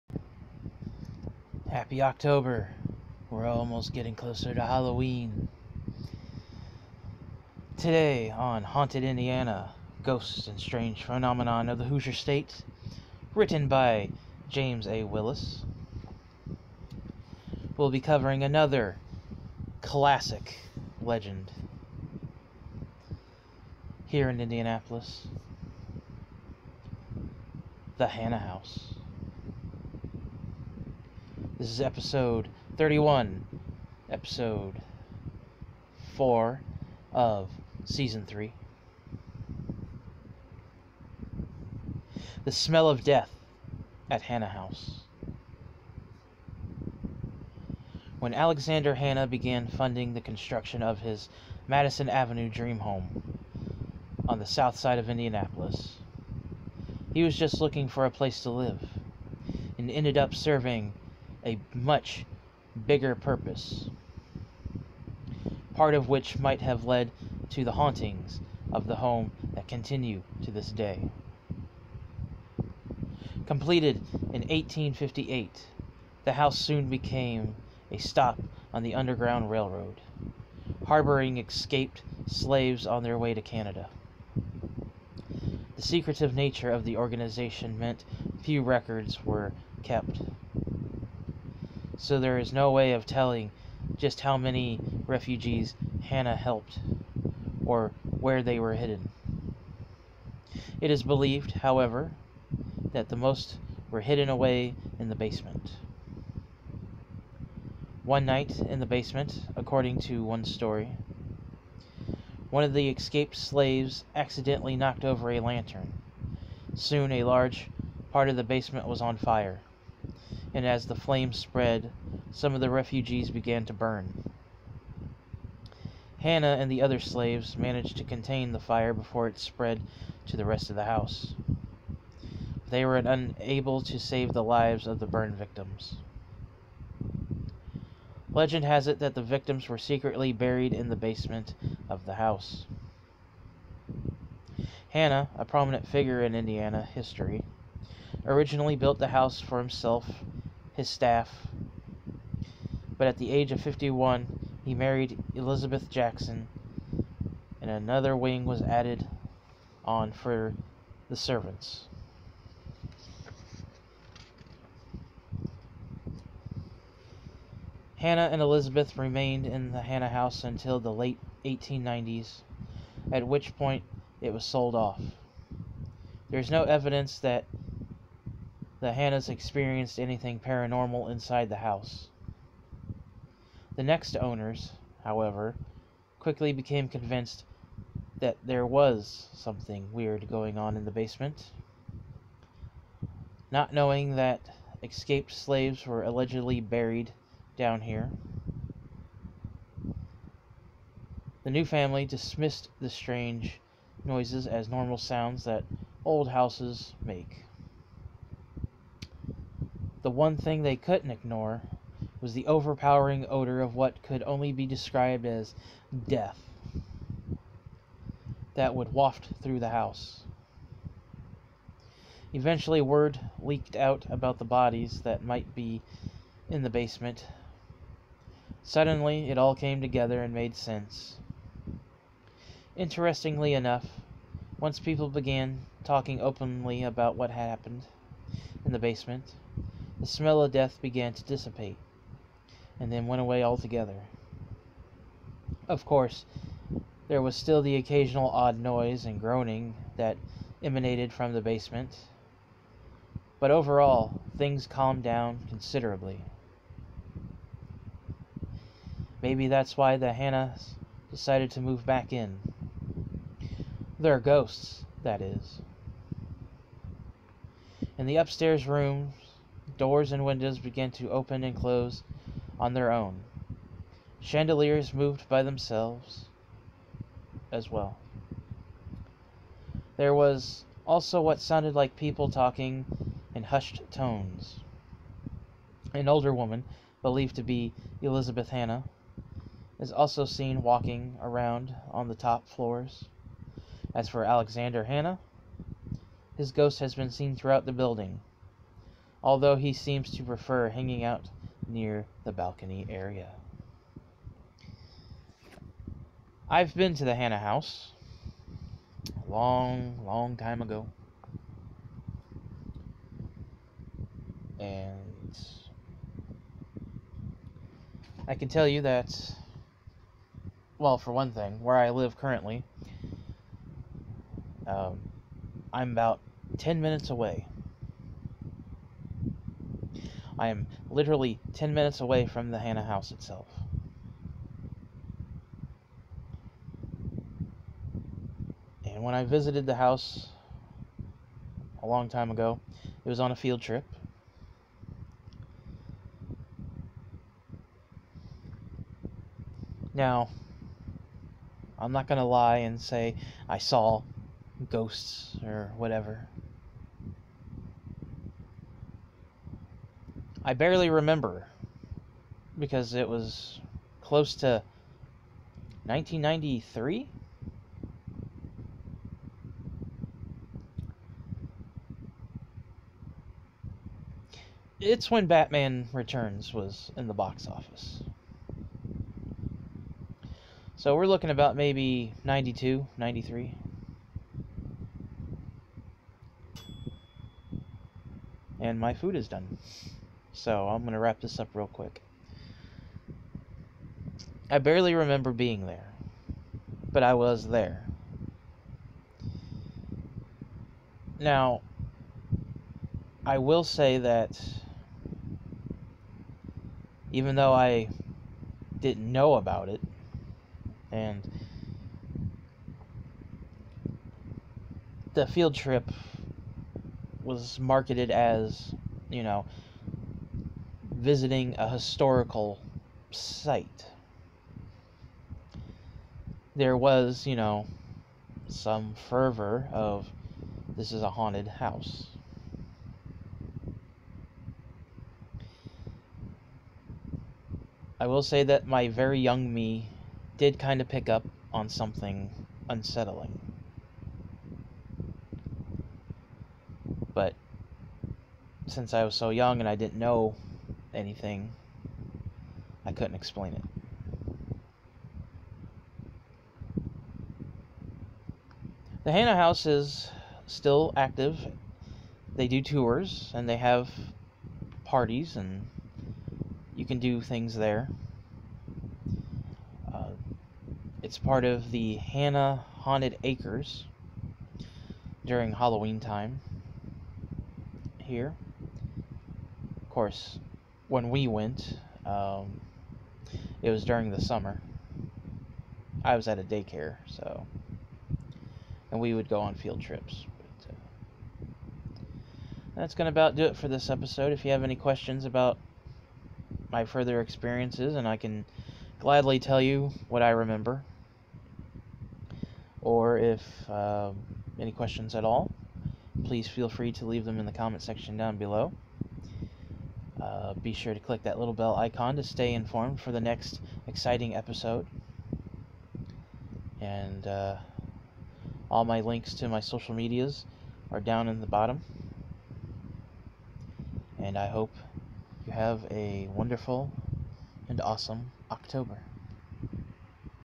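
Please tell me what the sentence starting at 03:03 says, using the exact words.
The next owners, however, quickly became convinced that there was something weird going on in the basement.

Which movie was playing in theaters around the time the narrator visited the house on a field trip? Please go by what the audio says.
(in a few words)
Batman Returns.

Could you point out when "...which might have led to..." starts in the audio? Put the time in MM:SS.
01:06.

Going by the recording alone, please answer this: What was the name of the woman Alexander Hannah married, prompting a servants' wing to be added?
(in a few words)
Elizabeth Jackson.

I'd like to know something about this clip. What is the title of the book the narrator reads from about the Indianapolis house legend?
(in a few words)
Haunted Indiana.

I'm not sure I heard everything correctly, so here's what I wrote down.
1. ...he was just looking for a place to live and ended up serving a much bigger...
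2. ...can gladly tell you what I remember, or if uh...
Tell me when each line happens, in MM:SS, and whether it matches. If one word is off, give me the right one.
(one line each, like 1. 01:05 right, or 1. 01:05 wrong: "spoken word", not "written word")
1. 00:57 right
2. 08:18 right.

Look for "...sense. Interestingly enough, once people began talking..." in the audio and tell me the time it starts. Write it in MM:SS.
03:50.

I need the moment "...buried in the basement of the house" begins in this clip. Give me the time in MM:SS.
02:20.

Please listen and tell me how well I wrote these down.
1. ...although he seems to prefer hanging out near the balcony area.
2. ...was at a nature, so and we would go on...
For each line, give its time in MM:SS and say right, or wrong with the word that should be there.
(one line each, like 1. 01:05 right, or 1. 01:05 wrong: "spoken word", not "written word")
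1. 04:59 right
2. 08:06 wrong: "daycare", not "nature".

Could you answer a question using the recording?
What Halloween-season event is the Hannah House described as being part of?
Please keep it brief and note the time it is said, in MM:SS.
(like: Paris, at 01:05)
Hannah Haunted Acres, at 07:51.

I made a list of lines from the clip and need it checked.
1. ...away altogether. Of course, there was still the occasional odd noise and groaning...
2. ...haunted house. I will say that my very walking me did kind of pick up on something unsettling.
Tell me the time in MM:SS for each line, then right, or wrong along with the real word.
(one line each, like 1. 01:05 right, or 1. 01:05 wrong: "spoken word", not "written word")
1. 04:03 right
2. 07:11 wrong: "young", not "walking".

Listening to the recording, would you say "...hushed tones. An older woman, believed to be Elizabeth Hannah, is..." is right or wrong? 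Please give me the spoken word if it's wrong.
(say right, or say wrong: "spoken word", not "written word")
right.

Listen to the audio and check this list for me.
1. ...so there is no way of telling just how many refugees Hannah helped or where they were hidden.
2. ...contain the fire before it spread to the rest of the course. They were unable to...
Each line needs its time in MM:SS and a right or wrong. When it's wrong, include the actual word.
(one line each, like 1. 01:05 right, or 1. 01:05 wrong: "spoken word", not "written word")
1. 01:32 right
2. 02:08 wrong: "house", not "course".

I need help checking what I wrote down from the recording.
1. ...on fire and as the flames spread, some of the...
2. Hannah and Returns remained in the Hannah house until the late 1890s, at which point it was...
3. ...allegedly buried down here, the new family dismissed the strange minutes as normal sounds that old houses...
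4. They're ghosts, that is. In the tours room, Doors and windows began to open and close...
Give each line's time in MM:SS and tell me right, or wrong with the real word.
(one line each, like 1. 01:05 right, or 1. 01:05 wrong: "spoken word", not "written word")
1. 01:59 right
2. 02:47 wrong: "Elizabeth", not "Returns"
3. 03:16 wrong: "noises", not "minutes"
4. 04:23 wrong: "upstairs", not "tours".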